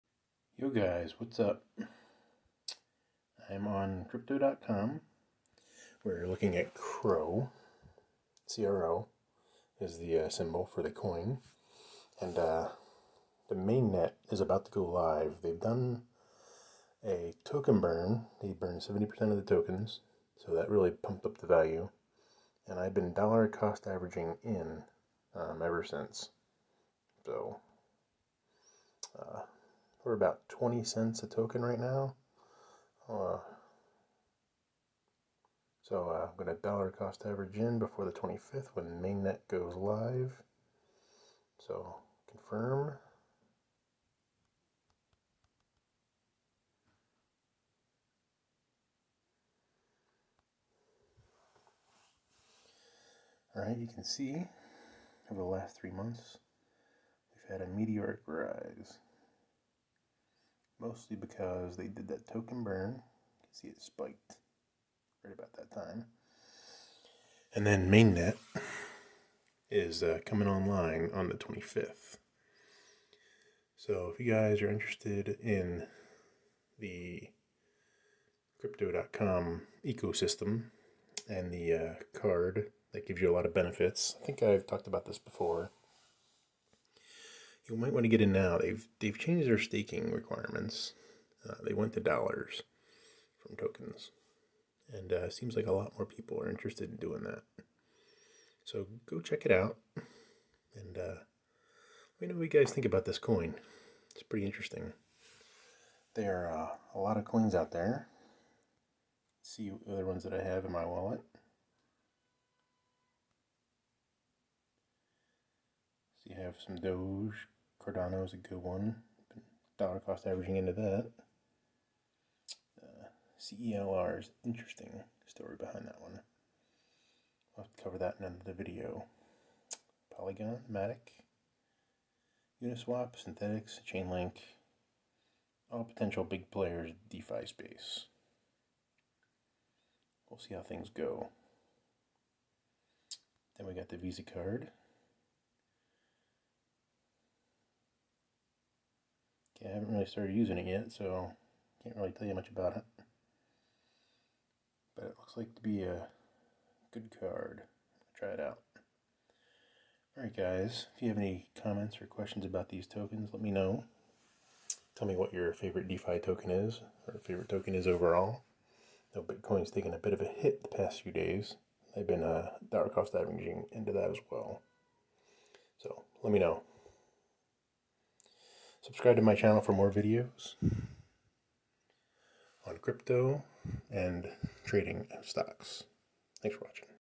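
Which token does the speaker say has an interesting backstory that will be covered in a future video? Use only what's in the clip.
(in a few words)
CELR.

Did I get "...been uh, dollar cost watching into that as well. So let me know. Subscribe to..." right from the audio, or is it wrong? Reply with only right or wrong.
wrong.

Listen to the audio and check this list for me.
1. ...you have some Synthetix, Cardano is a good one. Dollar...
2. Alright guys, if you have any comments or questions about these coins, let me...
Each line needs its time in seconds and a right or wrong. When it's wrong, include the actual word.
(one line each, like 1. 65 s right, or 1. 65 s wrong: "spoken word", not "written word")
1. 116 s wrong: "Doge", not "Synthetix"
2. 160 s wrong: "tokens", not "coins".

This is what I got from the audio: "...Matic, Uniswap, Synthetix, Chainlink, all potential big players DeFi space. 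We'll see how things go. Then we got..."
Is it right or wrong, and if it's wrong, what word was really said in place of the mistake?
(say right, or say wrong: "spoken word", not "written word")
right.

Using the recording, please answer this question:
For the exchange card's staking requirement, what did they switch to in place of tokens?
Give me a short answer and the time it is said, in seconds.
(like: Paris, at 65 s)
Dollars, at 92 s.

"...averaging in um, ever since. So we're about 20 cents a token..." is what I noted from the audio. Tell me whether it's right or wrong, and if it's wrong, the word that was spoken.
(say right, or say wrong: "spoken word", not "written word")
right.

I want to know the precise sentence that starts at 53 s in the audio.
All right, you can see over the last three months, we've had a meteoric rise mostly because they did that token burn.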